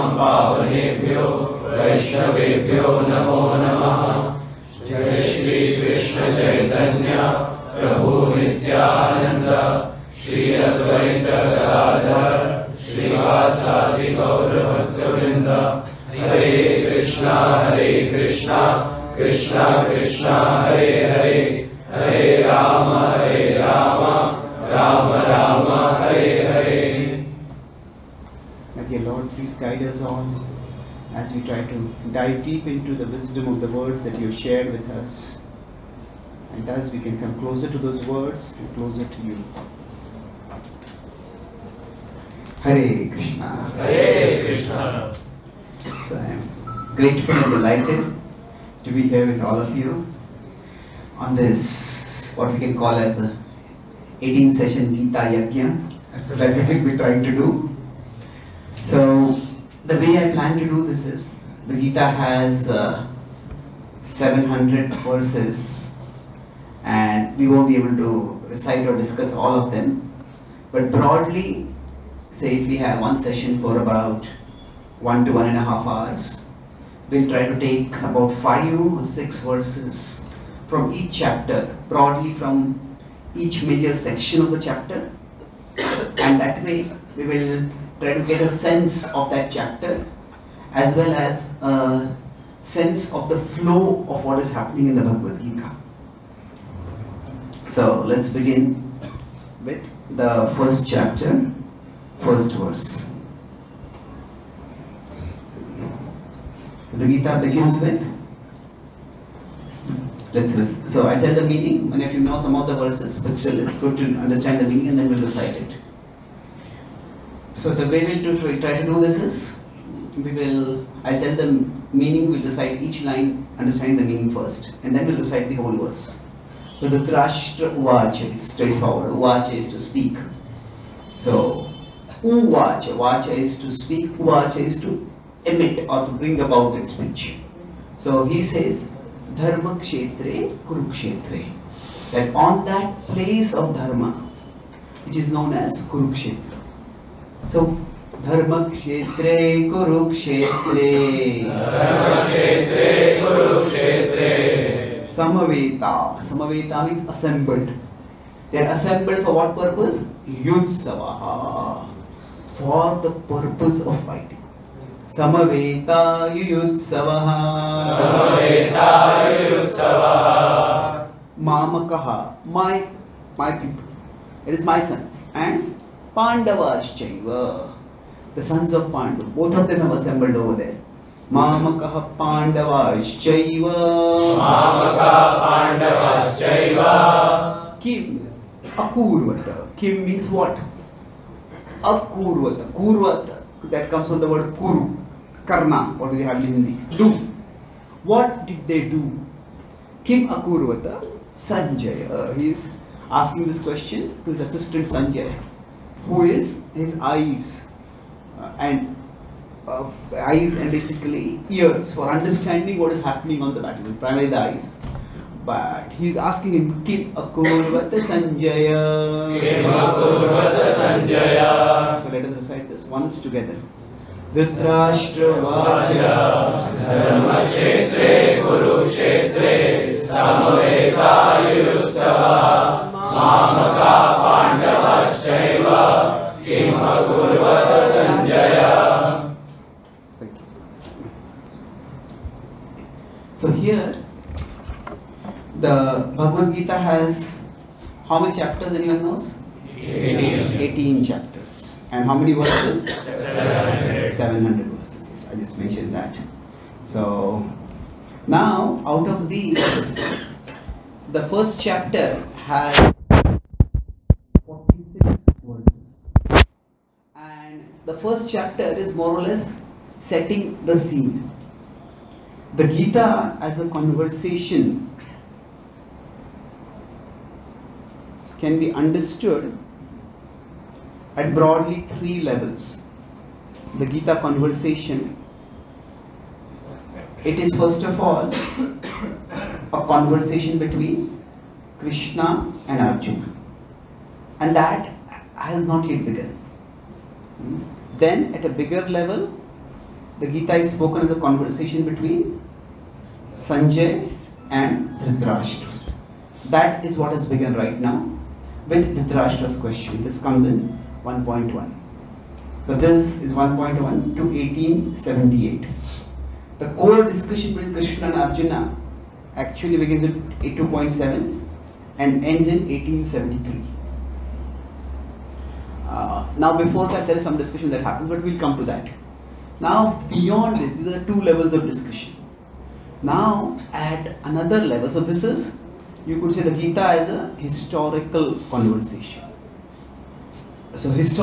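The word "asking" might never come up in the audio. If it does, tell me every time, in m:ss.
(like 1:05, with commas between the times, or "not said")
3:23, 3:36.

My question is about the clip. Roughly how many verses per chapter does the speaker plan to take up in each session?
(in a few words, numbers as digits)
five or six.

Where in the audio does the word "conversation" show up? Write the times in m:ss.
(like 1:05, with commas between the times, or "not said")
4:33, 4:44, 4:49, 5:01, 5:38.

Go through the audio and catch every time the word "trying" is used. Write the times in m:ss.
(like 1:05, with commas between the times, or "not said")
0:56.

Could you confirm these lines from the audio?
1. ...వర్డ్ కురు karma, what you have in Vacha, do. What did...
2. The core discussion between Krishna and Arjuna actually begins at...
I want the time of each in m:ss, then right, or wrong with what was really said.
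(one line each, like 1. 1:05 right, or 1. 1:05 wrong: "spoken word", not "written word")
1. 3:14 wrong: "Hindi", not "Vacha"
2. 5:16 right.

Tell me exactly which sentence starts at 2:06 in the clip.
So the Dhrashtra Uvacha, it's straightforward.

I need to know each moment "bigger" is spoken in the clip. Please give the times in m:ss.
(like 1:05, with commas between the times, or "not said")
4:58.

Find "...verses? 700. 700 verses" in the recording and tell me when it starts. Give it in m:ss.
4:12.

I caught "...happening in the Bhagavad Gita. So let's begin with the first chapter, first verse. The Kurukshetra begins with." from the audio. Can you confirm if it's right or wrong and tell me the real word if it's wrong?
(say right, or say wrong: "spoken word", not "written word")
wrong: "Gita", not "Kurukshetra".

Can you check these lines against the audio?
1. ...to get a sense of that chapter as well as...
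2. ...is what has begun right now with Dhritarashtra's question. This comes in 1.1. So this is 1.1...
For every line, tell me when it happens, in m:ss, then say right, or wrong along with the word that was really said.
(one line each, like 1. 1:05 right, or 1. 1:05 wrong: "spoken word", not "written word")
1. 1:28 right
2. 5:06 right.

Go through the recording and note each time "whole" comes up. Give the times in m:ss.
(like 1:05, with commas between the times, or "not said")
2:05.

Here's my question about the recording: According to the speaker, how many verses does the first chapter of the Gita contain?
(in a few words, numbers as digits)
46.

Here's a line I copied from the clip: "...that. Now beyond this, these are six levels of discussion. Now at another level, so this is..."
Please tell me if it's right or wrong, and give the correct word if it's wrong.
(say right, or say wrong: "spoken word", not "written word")
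wrong: "two", not "six".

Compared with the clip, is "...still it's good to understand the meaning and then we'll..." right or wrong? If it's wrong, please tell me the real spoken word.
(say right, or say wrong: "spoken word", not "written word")
right.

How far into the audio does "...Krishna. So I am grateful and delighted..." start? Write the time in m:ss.
0:44.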